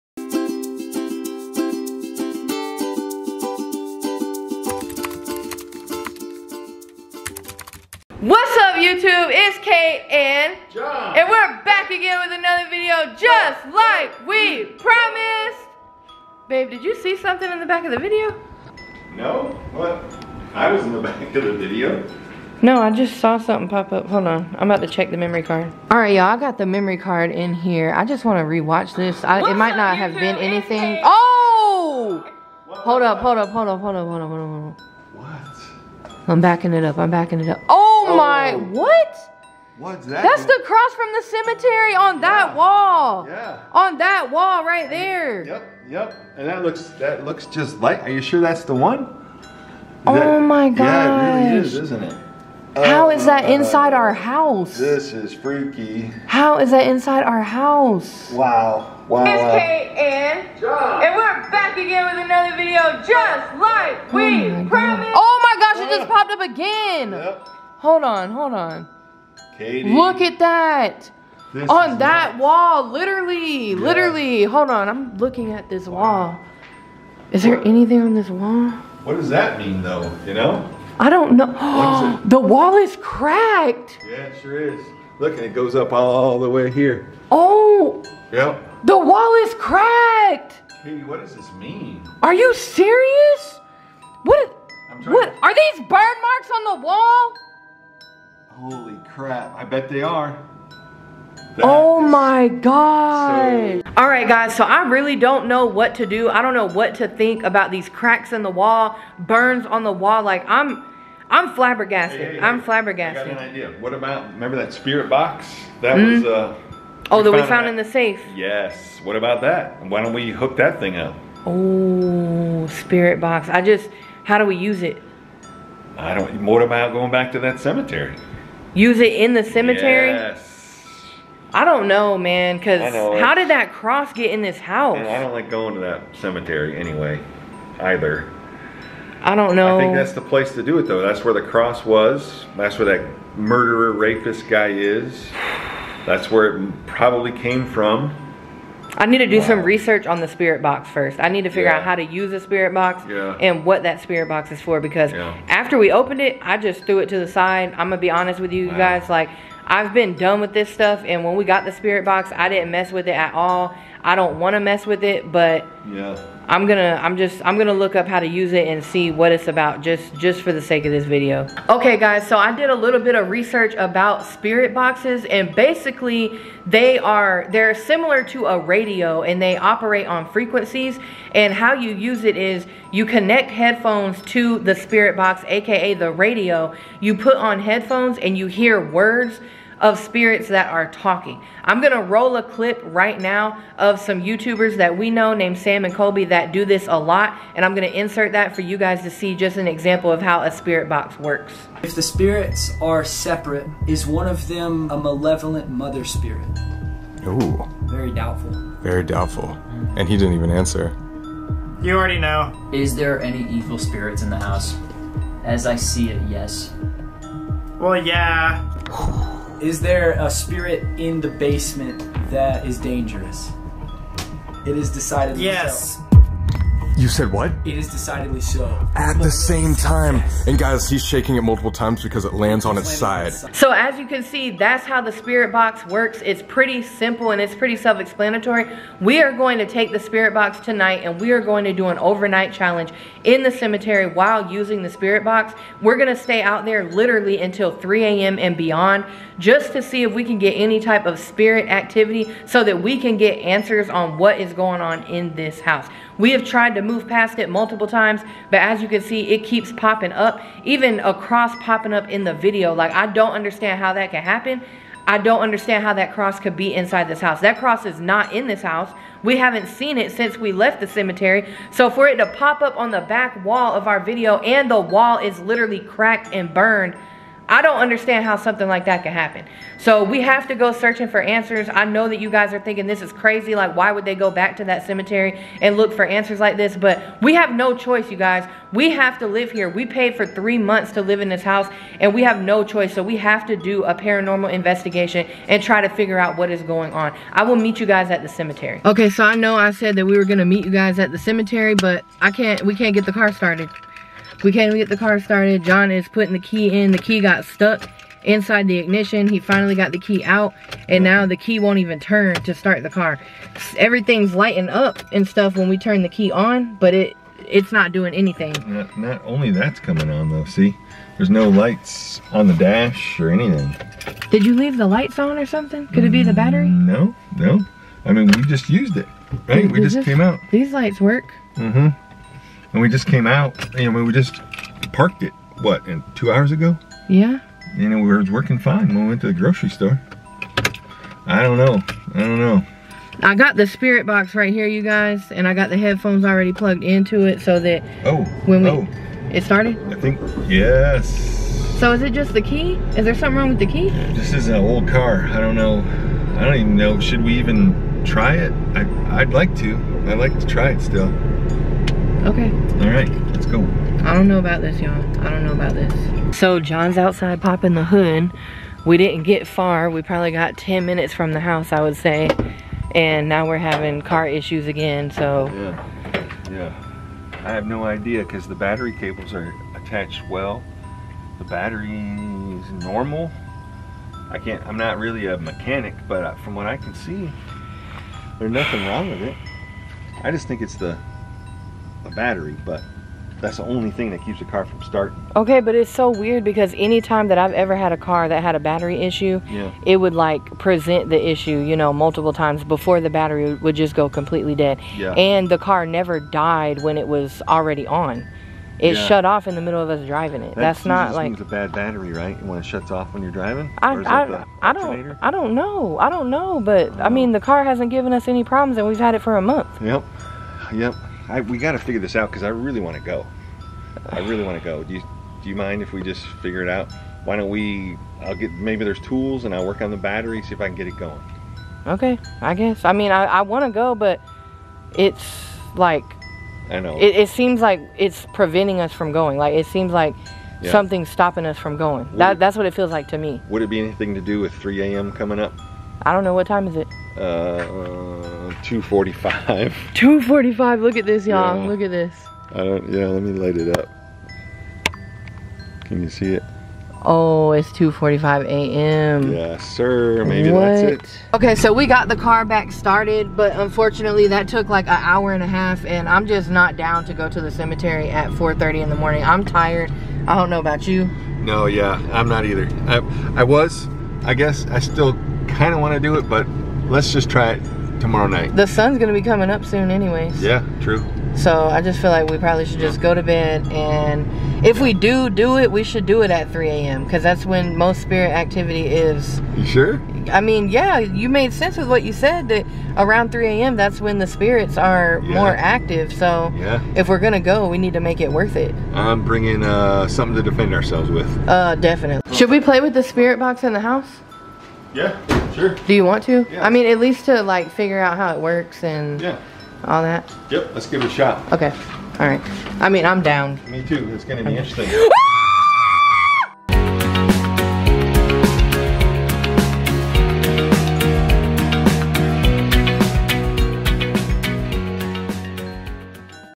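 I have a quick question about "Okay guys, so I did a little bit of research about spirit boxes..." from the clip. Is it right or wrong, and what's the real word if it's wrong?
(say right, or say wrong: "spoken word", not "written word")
right.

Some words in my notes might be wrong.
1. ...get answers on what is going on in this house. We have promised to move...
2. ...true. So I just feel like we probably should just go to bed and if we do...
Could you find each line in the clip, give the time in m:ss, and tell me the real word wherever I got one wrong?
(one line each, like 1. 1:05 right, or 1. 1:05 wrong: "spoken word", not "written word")
1. 4:13 wrong: "tried", not "promised"
2. 8:00 right.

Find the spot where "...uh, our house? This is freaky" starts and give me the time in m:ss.
0:53.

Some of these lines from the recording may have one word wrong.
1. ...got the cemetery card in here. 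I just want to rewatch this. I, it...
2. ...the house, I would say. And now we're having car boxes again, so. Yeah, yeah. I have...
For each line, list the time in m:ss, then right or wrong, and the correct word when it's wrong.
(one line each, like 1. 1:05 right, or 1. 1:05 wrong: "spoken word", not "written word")
1. 0:26 wrong: "memory", not "cemetery"
2. 6:11 wrong: "issues", not "boxes".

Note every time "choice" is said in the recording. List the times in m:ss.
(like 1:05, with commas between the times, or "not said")
4:47, 4:52.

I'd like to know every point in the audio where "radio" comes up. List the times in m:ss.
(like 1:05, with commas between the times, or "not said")
2:58, 3:06.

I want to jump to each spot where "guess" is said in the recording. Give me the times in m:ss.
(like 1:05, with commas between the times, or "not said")
7:12, 7:54.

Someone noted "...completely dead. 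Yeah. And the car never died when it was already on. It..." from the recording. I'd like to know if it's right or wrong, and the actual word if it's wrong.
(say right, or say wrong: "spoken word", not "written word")
right.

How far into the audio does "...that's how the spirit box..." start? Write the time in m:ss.
3:54.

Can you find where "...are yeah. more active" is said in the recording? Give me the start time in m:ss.
8:14.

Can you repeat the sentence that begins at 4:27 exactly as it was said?
That cross is not in this house.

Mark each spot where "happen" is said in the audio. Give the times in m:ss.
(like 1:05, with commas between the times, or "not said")
4:24, 4:39.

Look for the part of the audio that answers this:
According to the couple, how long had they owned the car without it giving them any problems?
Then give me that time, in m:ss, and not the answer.
6:59.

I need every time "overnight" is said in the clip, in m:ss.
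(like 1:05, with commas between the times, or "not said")
4:01.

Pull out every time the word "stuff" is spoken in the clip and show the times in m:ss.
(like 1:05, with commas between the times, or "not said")
2:40, 5:15.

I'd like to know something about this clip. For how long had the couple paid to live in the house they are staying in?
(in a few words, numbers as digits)
3 months.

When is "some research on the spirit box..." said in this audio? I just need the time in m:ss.
2:29.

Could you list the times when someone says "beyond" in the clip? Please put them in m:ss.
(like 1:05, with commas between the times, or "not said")
4:08.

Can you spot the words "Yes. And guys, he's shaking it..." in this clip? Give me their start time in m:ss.
3:50.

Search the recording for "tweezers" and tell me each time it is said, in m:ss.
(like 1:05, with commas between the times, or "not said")
not said.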